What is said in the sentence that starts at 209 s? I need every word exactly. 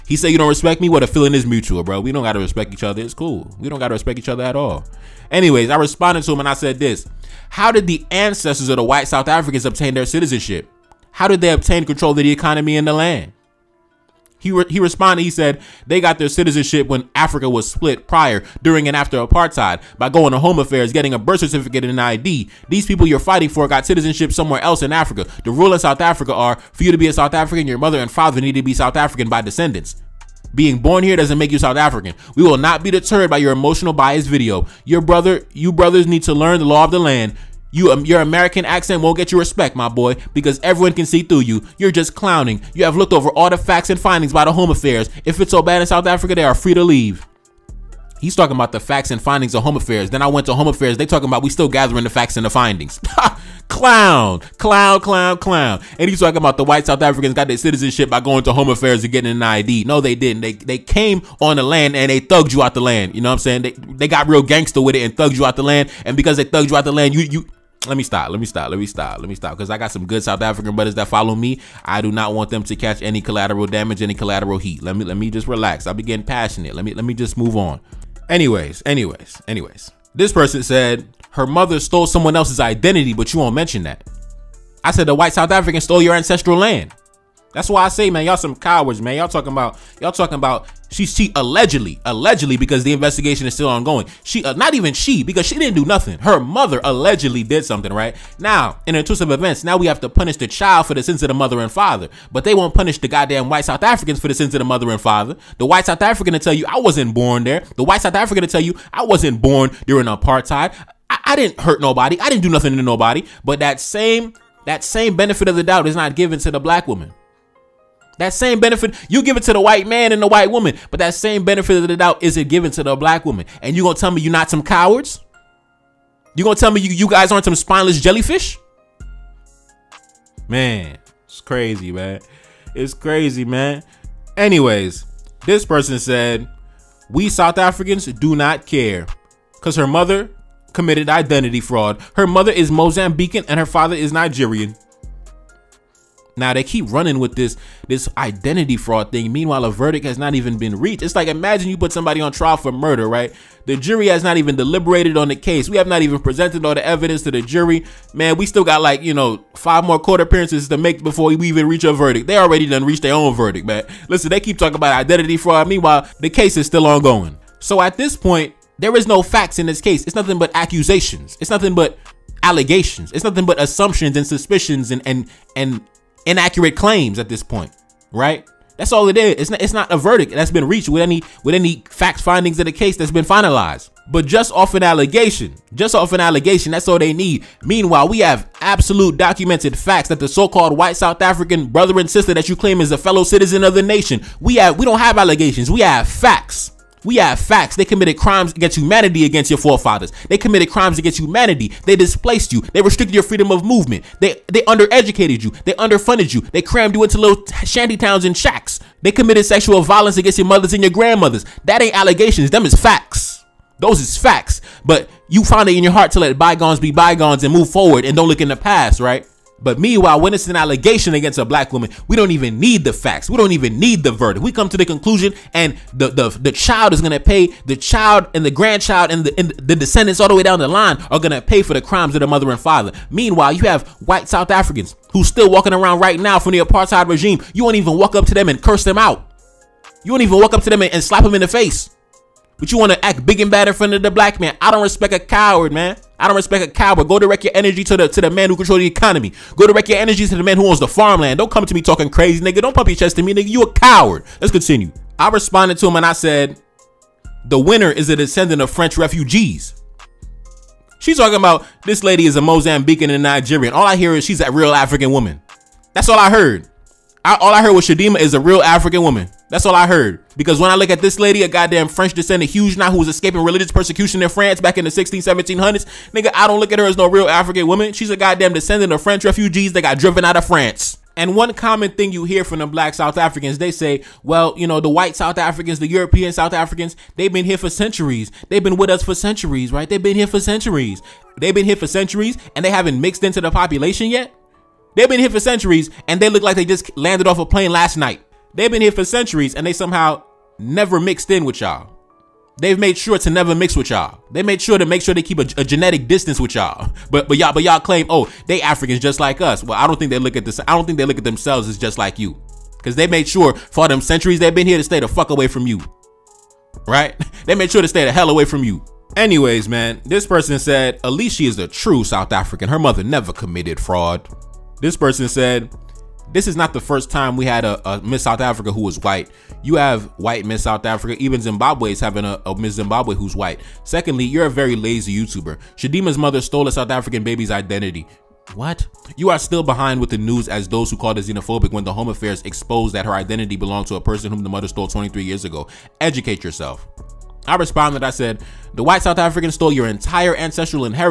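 They committed sexual violence against your mothers and your grandmothers.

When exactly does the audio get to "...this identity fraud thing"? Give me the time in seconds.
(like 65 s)
147 s.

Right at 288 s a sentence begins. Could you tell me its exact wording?
They've been with us for centuries, right?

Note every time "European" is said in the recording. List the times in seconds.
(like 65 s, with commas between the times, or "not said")
285 s.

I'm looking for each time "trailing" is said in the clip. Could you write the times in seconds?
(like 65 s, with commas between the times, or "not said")
not said.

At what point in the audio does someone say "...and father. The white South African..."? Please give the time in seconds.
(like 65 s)
104 s.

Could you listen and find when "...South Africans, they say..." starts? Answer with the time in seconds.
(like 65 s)
282 s.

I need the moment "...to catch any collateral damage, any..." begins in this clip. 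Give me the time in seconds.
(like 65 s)
72 s.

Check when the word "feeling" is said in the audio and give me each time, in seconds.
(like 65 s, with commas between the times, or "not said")
1 s.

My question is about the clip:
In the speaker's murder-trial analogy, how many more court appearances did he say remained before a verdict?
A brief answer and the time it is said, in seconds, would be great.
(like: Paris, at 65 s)
5, at 159 s.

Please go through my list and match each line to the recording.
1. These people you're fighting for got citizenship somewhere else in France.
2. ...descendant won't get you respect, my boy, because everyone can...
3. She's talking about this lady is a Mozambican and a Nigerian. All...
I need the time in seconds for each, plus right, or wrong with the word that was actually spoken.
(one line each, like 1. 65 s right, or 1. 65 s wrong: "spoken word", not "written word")
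1. 22 s wrong: "Africa", not "France"
2. 38 s wrong: "accent", not "descendant"
3. 260 s right.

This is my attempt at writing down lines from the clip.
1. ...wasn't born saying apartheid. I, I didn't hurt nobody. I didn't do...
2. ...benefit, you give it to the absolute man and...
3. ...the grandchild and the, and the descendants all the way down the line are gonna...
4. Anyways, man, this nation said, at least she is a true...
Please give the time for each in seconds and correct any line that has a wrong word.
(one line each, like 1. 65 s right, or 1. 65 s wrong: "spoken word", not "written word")
1. 109 s wrong: "during", not "saying"
2. 118 s wrong: "white", not "absolute"
3. 228 s right
4. 319 s wrong: "person", not "nation".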